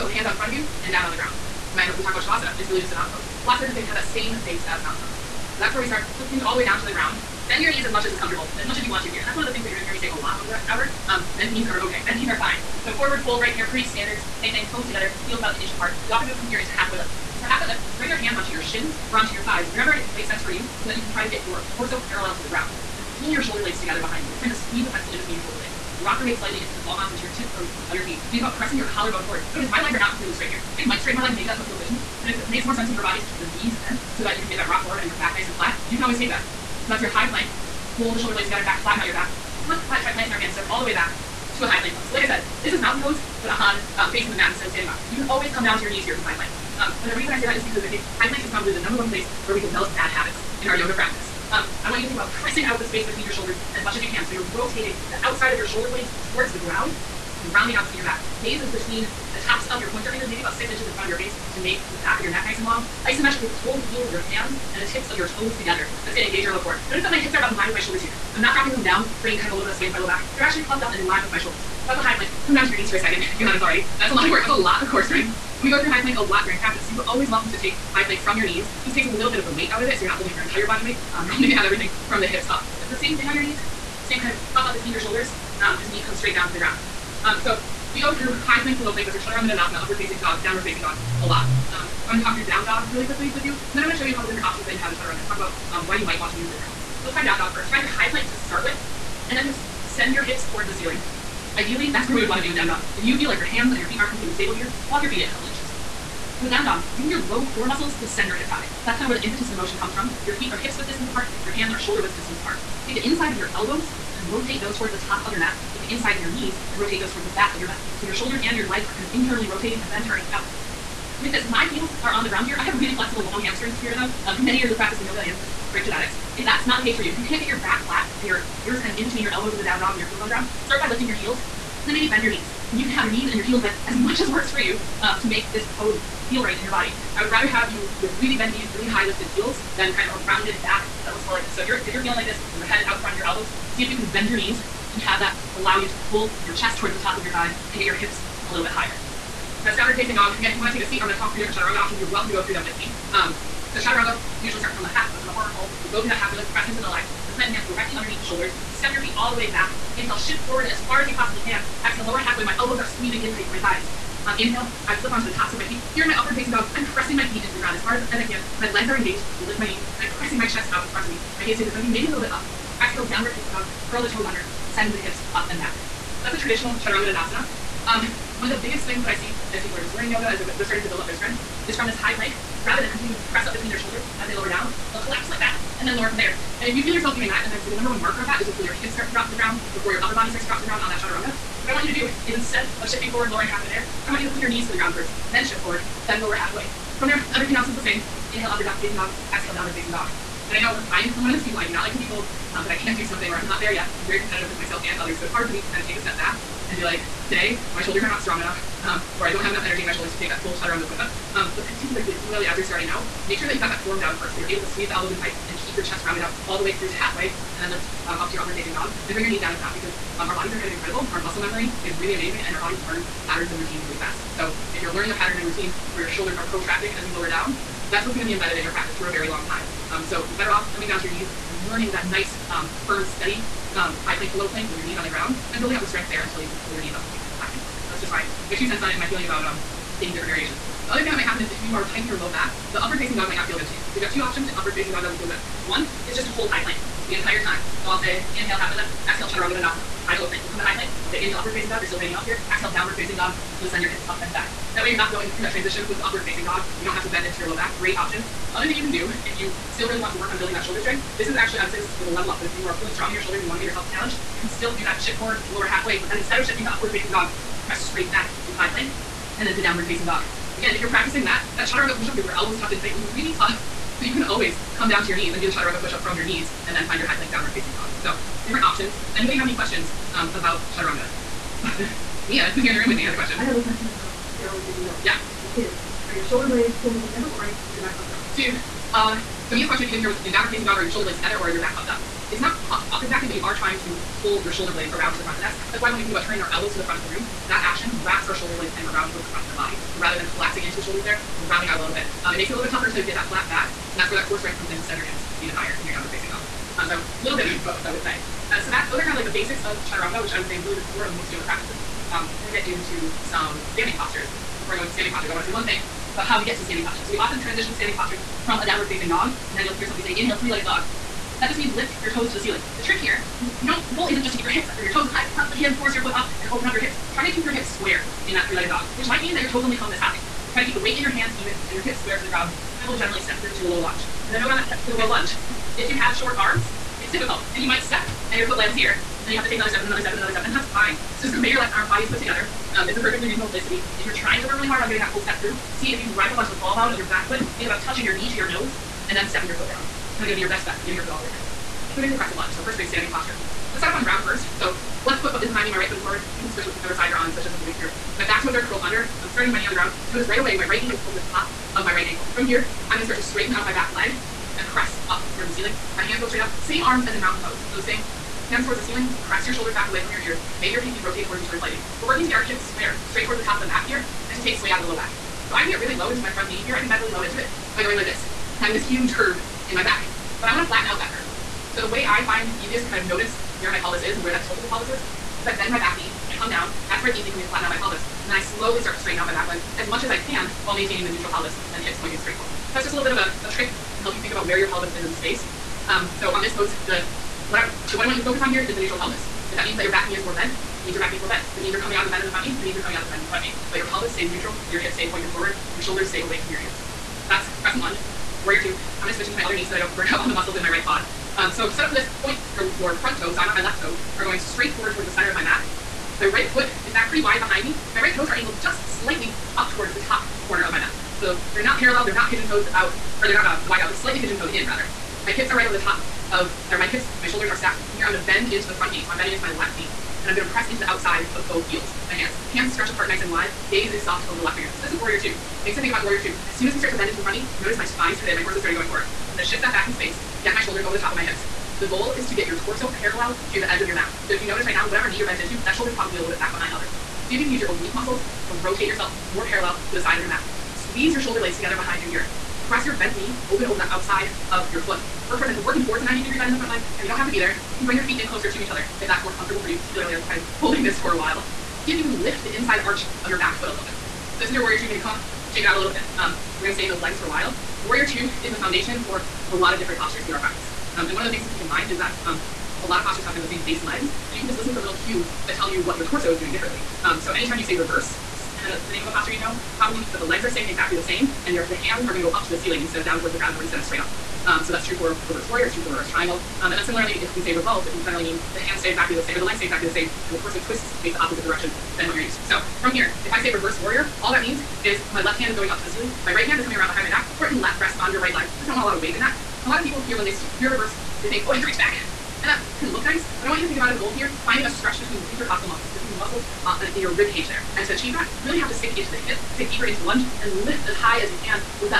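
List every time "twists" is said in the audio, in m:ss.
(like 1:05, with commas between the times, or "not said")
8:10.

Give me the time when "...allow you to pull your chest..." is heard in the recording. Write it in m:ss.
2:25.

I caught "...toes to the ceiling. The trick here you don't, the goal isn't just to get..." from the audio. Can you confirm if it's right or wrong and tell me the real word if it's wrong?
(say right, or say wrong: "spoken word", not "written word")
right.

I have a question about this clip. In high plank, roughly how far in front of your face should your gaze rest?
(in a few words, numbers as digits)
about 6 inches.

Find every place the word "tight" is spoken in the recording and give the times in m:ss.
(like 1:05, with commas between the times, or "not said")
2:43, 3:35, 4:01, 4:32.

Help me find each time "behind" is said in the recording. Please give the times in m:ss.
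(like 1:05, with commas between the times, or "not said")
0:24, 5:55, 6:57, 7:26, 7:31, 8:16.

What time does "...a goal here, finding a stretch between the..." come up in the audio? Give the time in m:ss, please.
8:23.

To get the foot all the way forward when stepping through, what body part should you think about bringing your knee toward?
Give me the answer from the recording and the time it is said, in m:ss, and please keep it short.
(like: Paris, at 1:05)
your nose, at 5:47.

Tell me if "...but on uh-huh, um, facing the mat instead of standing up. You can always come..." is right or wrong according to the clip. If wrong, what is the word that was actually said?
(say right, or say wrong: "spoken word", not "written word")
right.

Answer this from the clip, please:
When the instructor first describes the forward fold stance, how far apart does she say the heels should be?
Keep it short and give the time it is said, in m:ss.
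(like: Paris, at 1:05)
about an inch, at 0:15.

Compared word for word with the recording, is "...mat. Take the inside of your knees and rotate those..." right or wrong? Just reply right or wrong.
right.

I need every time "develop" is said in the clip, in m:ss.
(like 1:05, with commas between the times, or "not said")
0:49.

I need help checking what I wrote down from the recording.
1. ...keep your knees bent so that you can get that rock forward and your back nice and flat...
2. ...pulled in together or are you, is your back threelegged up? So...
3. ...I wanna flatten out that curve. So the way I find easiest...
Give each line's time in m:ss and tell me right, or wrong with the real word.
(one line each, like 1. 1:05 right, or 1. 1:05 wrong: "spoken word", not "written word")
1. 0:33 right
2. 4:46 wrong: "puffed", not "threelegged"
3. 6:20 right.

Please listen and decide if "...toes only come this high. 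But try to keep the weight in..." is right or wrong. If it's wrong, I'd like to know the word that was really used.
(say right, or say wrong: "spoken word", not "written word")
right.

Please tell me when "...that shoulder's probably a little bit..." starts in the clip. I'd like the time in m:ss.
7:25.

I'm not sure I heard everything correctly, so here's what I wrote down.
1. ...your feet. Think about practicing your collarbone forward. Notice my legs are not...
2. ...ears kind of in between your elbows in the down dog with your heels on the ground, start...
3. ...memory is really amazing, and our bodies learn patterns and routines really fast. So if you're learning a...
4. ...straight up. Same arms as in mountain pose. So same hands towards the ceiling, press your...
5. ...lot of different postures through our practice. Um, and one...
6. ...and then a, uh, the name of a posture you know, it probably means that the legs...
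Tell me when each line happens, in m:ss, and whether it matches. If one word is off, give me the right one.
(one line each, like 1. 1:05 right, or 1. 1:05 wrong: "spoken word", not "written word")
1. 0:27 wrong: "pressing", not "practicing"
2. 2:08 right
3. 3:41 right
4. 6:06 right
5. 7:49 right
6. 7:58 right.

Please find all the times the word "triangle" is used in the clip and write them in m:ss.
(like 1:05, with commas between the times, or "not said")
8:06.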